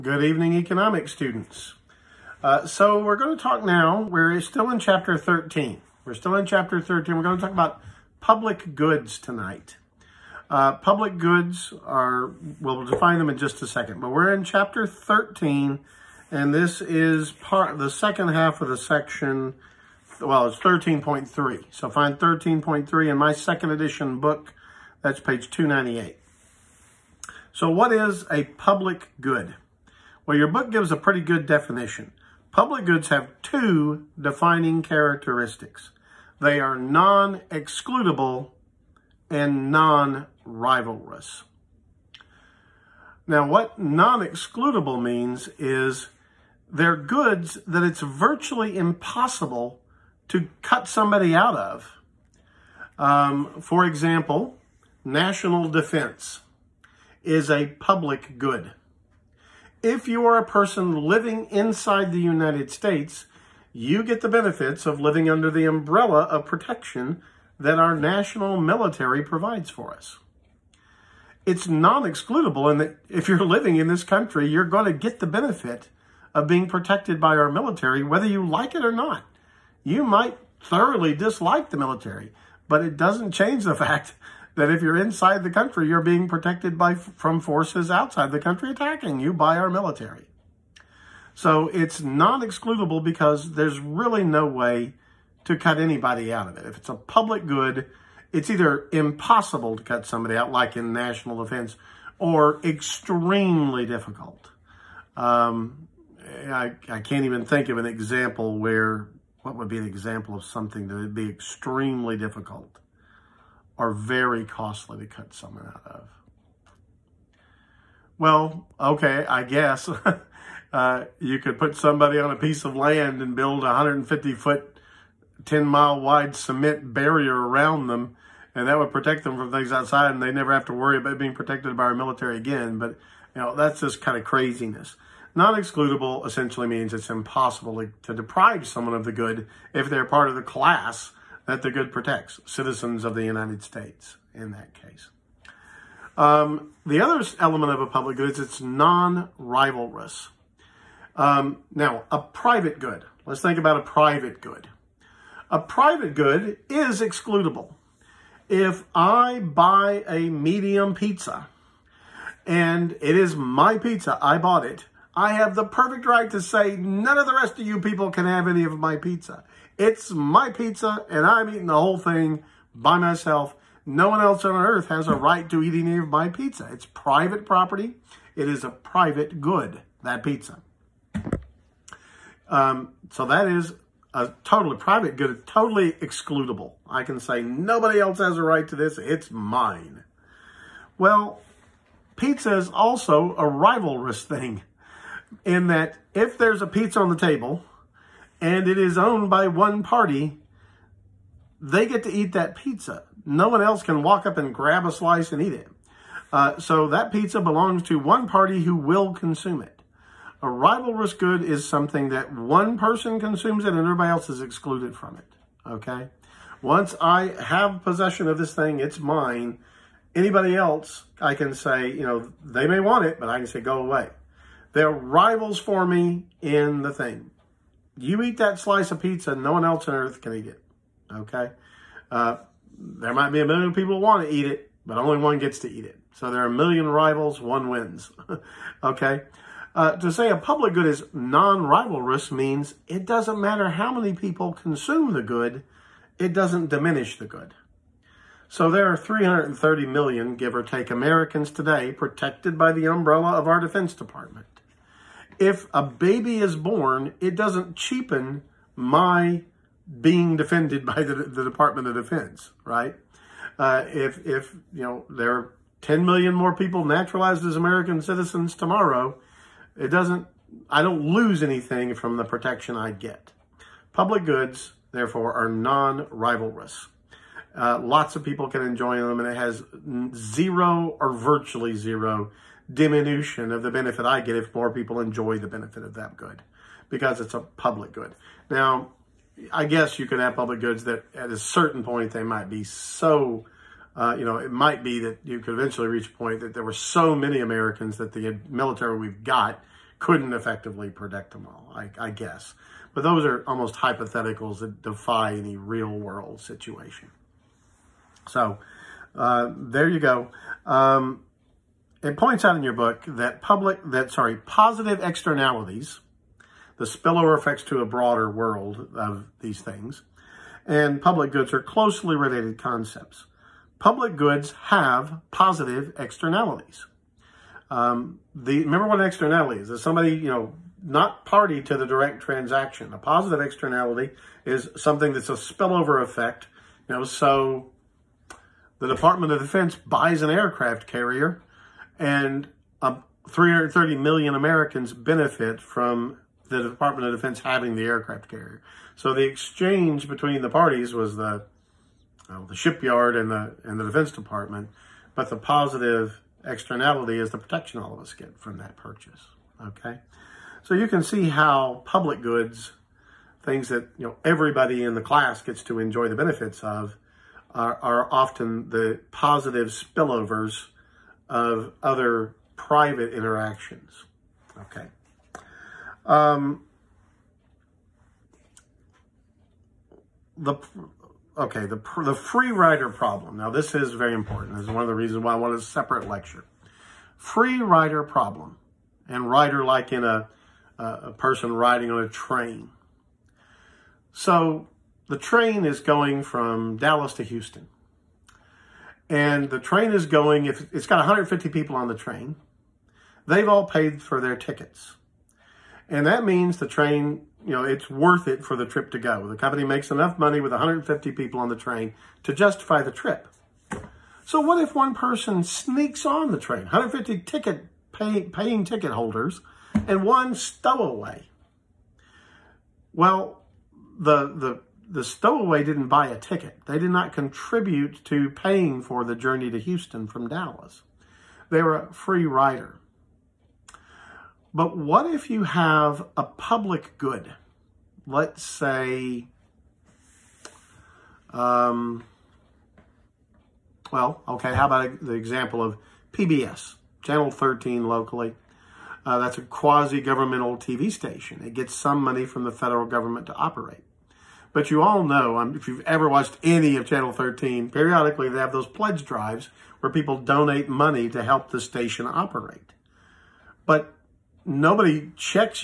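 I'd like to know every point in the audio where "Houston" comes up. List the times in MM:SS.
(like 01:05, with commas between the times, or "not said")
06:37, 07:09.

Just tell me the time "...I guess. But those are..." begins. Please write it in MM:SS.
05:01.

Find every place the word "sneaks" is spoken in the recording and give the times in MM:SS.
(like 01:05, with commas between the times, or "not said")
06:55.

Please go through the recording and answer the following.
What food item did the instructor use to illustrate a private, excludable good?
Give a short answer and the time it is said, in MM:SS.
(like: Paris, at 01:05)
medium pizza, at 02:40.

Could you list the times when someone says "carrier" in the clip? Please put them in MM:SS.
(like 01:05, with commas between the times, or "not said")
05:40, 05:48.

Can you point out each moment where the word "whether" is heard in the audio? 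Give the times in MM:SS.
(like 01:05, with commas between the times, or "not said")
01:18.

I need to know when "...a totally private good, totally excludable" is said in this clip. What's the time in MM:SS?
03:04.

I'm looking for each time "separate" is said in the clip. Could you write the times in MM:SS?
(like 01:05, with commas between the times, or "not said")
06:25.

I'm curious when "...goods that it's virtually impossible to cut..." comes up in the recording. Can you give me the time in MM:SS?
00:46.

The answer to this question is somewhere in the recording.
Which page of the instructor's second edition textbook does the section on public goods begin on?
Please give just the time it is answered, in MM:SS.
00:25.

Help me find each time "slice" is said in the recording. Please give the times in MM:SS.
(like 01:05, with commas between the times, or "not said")
03:24, 03:48.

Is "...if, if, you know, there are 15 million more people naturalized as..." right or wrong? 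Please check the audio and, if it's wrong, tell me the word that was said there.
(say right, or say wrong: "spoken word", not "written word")
wrong: "10", not "15".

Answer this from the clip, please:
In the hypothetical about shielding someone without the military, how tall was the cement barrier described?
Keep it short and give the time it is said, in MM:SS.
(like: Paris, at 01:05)
150 foot, at 02:03.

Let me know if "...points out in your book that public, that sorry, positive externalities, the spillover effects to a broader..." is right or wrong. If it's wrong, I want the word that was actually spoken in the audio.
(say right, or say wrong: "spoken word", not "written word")
right.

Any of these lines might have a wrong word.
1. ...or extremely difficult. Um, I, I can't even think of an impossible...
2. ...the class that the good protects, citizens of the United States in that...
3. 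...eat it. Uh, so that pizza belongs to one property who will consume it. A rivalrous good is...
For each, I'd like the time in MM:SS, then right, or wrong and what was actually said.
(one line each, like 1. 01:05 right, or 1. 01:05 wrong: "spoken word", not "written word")
1. 01:42 wrong: "example", not "impossible"
2. 02:20 right
3. 03:25 wrong: "party", not "property".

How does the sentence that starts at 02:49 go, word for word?
It's my pizza, and I'm eating the whole thing by myself.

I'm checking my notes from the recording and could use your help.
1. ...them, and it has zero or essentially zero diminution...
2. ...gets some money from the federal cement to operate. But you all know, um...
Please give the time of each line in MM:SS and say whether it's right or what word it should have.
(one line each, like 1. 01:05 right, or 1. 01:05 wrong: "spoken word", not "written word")
1. 04:38 wrong: "virtually", not "essentially"
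2. 07:31 wrong: "government", not "cement".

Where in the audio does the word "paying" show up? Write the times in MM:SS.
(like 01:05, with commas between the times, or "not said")
06:58, 07:08.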